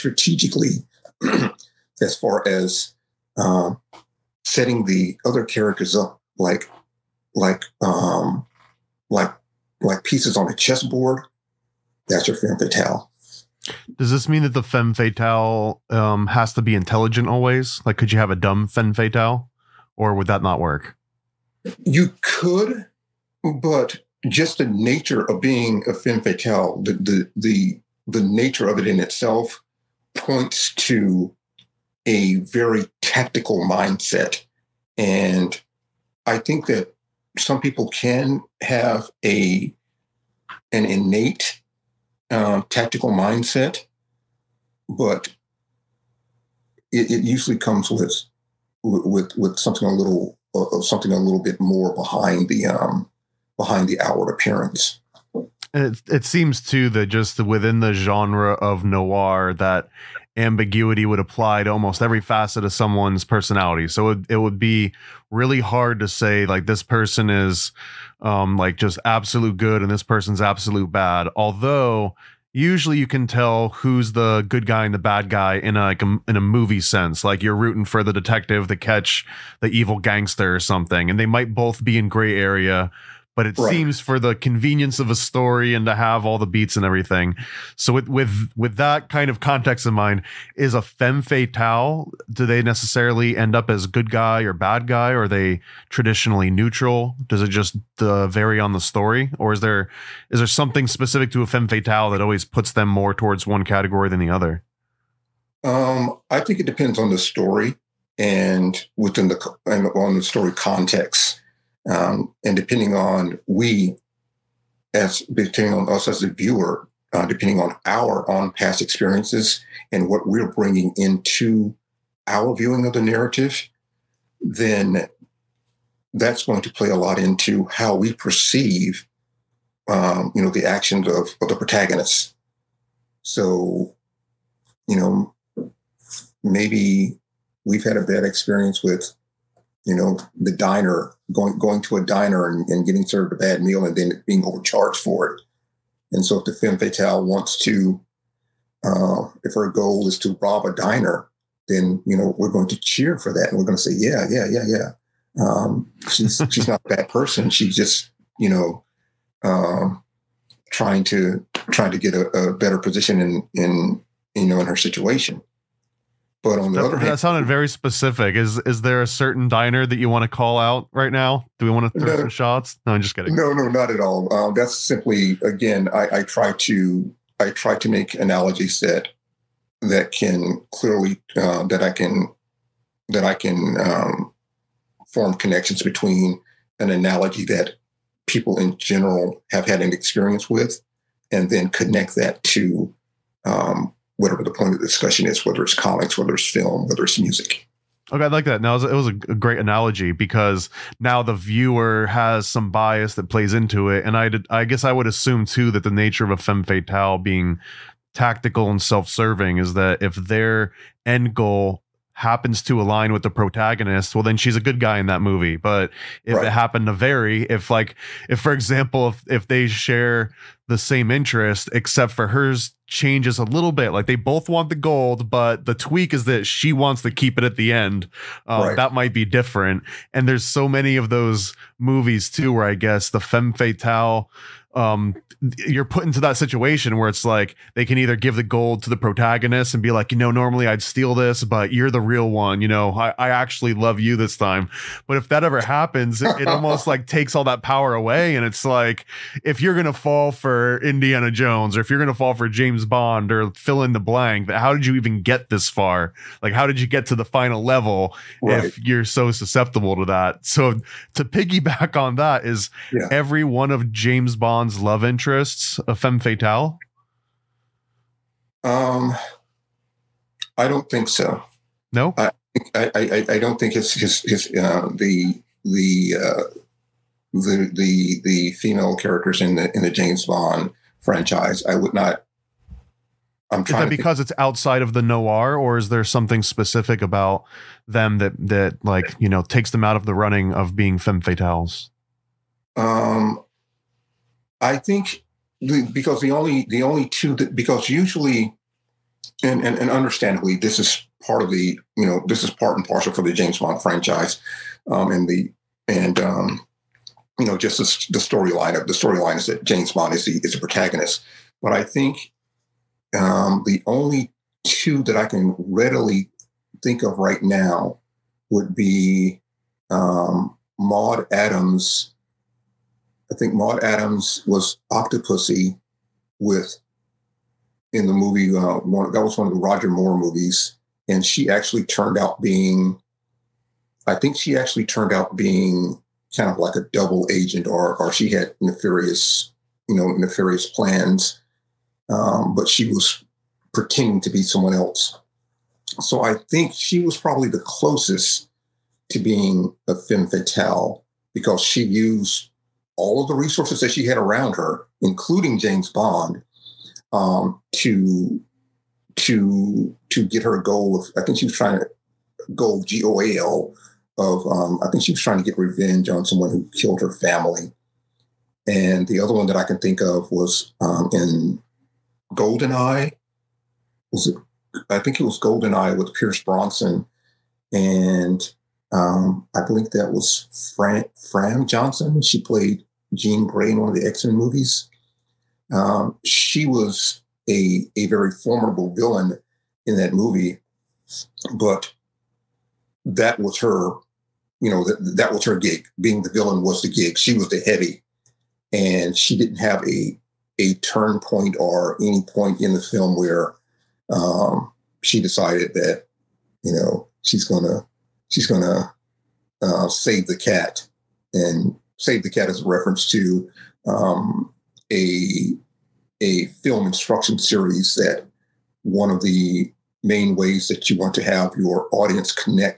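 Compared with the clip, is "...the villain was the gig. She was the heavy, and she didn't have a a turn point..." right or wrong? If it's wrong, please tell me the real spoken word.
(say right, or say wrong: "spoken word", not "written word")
right.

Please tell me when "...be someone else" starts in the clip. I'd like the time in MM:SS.
05:44.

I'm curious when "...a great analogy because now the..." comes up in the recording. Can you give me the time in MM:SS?
03:19.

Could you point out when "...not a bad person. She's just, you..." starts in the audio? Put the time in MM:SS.
02:36.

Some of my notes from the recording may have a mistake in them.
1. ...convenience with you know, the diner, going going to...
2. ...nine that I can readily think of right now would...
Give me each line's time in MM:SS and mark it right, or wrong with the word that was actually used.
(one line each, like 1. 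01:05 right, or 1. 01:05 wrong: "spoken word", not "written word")
1. 02:18 wrong: "experience", not "convenience"
2. 05:14 wrong: "two", not "nine".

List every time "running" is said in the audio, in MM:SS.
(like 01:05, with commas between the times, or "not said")
04:50.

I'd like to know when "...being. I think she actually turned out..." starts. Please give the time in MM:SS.
05:32.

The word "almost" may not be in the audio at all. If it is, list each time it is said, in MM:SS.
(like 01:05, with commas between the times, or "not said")
01:01, 04:06.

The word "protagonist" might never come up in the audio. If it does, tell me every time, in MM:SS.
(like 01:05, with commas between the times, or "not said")
02:11, 03:33, 03:58, 05:10.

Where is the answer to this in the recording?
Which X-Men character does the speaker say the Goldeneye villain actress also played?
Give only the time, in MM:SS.
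06:23.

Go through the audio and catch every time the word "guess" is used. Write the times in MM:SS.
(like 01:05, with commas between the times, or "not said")
03:24, 03:52.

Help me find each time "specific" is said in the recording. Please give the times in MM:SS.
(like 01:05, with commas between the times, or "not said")
01:40, 02:47, 04:46.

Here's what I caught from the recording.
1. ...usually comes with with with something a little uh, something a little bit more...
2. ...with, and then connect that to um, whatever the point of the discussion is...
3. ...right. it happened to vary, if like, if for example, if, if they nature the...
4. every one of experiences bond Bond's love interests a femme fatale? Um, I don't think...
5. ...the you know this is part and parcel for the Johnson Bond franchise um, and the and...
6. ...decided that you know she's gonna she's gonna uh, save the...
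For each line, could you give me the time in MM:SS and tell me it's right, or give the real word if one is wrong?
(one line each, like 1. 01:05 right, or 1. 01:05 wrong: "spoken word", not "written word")
1. 00:47 right
2. 03:10 right
3. 03:36 wrong: "share", not "nature"
4. 04:23 wrong: "james", not "experiences"
5. 05:01 wrong: "James", not "Johnson"
6. 06:45 right.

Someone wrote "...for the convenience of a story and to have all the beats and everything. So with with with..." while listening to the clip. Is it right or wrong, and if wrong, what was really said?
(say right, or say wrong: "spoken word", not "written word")
right.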